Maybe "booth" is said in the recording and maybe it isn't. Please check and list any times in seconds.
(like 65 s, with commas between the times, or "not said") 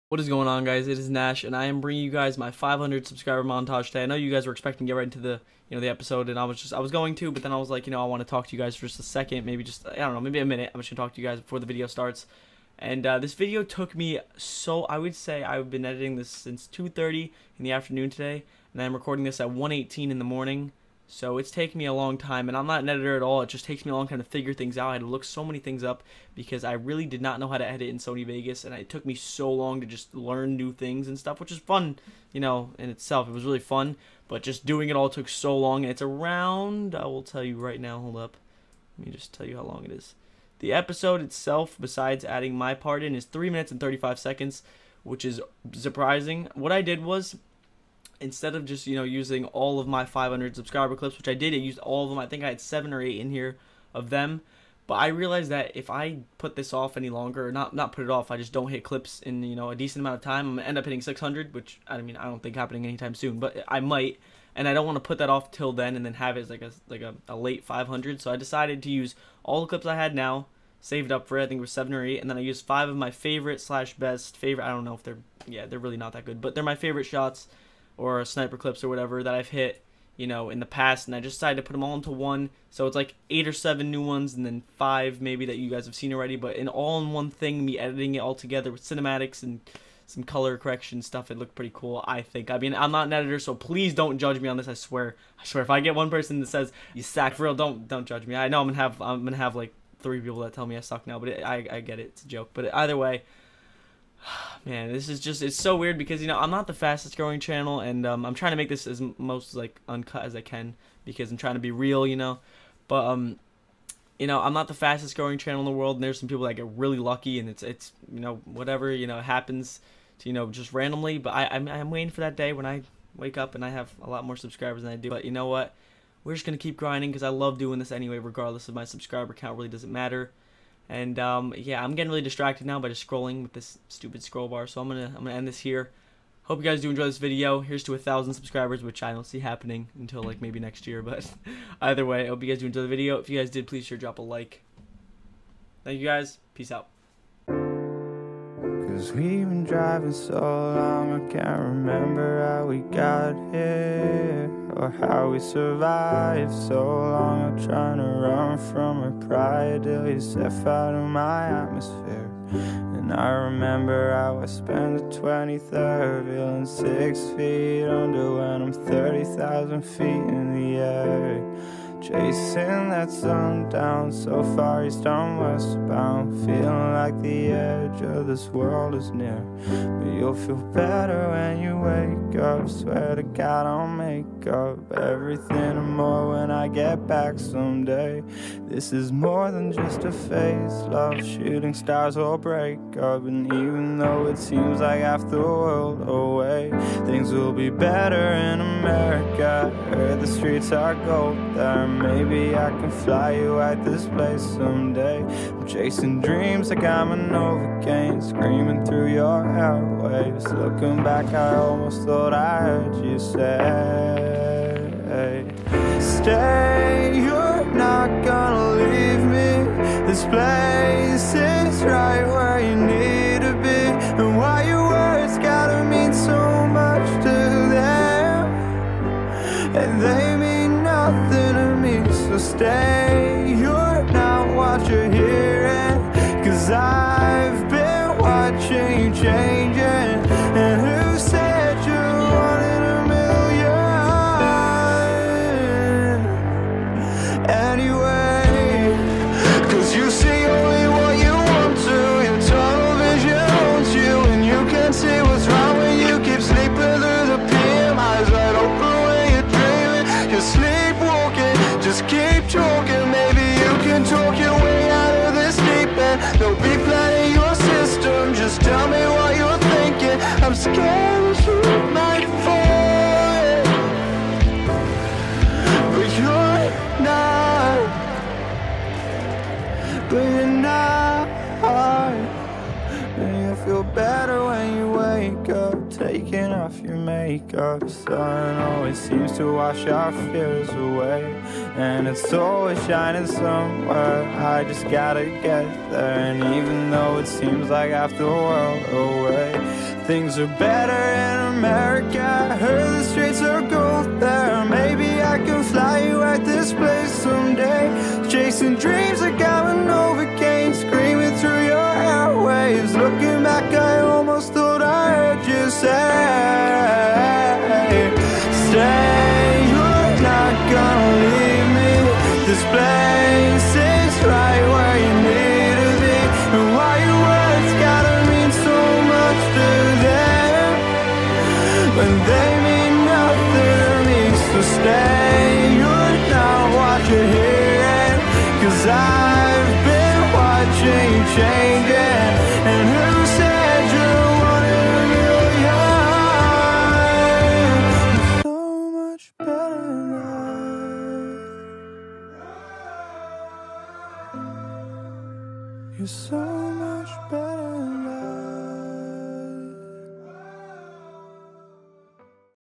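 not said.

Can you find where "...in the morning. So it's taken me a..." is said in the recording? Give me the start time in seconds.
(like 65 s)
20 s.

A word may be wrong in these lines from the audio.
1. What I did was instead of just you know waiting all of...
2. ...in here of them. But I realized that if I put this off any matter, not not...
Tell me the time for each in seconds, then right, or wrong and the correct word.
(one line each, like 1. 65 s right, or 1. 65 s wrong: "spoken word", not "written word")
1. 46 s wrong: "using", not "waiting"
2. 53 s wrong: "longer", not "matter".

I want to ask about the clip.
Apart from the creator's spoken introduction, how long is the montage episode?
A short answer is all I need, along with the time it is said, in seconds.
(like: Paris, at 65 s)
3 minutes 35 seconds, at 43 s.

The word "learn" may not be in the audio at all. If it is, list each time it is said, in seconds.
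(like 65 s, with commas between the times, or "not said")
30 s.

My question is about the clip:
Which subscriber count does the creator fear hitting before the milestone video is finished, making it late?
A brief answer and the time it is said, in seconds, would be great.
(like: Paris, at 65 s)
600, at 61 s.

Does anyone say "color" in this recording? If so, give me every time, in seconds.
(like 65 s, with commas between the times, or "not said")
90 s.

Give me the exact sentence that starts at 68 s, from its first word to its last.
So I decided to use all the clips I had now, saved up for it.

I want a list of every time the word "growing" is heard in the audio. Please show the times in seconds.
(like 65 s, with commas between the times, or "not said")
107 s, 115 s.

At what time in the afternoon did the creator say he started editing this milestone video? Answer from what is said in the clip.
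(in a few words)
2:30.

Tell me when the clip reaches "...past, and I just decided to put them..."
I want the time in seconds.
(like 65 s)
80 s.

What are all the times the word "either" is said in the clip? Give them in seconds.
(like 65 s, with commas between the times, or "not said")
102 s, 141 s.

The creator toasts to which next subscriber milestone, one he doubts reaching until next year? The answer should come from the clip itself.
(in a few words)
1,000.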